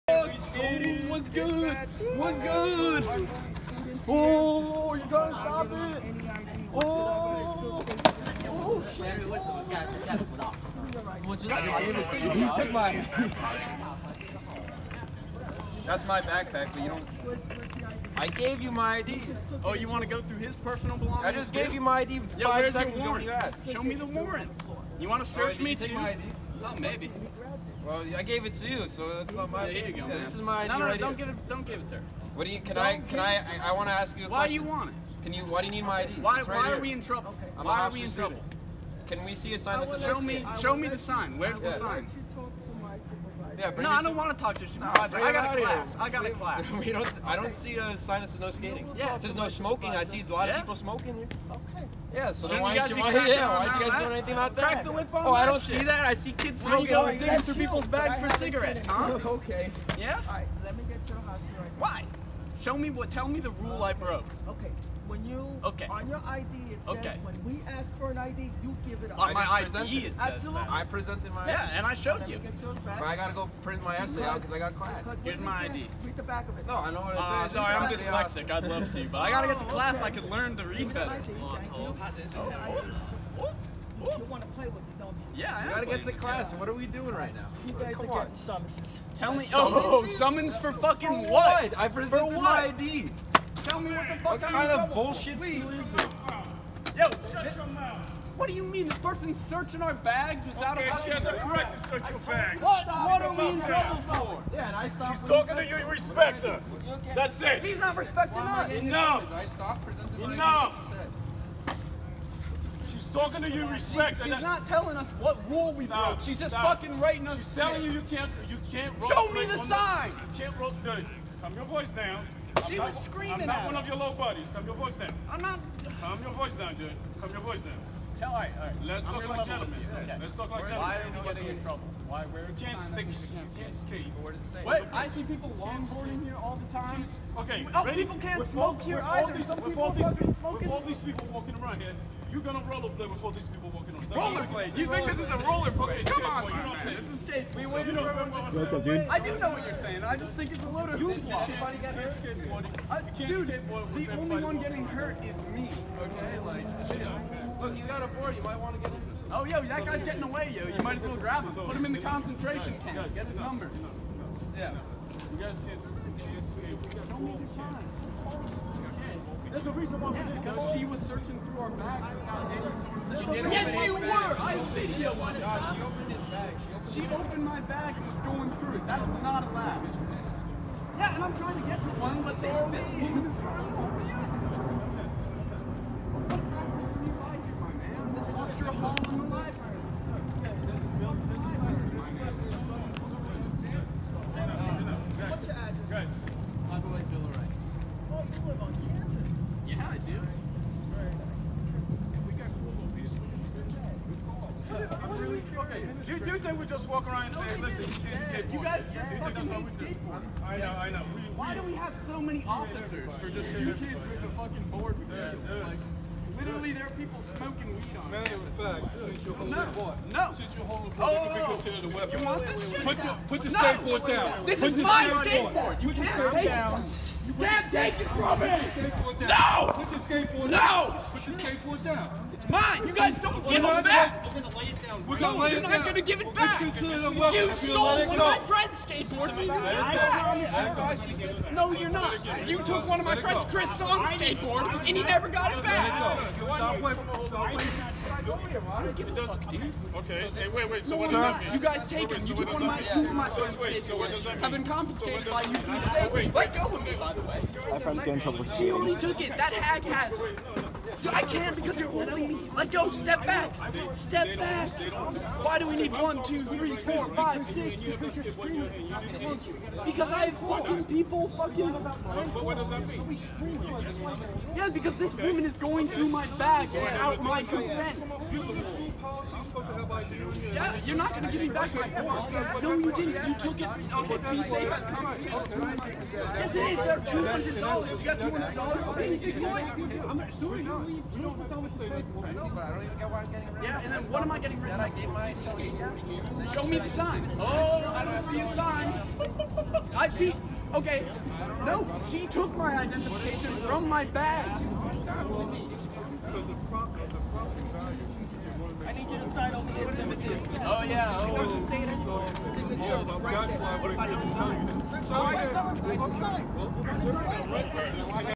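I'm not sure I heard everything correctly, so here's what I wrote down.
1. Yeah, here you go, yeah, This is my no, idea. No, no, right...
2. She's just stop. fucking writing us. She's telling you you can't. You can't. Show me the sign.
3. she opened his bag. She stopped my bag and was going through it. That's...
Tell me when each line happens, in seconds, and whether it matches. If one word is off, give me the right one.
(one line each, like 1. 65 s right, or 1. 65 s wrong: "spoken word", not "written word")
1. 29 s right
2. 116 s right
3. 175 s wrong: "opened", not "stopped".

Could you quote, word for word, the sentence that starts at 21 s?
I just gave you my ID five yeah, seconds ago Show me the warrant.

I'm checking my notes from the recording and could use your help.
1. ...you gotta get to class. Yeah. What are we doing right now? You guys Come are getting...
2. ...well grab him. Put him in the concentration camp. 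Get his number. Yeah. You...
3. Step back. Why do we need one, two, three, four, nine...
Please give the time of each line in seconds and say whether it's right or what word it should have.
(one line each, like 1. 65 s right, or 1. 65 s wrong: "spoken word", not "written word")
1. 85 s right
2. 161 s right
3. 263 s wrong: "five", not "nine".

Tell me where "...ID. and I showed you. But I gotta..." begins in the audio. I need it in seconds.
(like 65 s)
71 s.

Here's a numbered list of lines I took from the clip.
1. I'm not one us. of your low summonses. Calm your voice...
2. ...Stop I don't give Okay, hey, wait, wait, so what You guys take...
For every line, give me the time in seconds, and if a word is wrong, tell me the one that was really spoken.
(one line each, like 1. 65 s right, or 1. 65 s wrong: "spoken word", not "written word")
1. 123 s wrong: "buddies", not "summonses"
2. 246 s right.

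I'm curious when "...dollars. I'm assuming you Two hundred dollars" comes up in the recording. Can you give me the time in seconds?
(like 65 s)
288 s.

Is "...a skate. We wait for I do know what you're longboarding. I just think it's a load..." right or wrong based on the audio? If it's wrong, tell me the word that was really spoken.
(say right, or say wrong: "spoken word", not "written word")
wrong: "saying", not "longboarding".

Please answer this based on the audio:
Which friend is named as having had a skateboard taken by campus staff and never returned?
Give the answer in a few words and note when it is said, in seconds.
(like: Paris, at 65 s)
Chris Song, at 243 s.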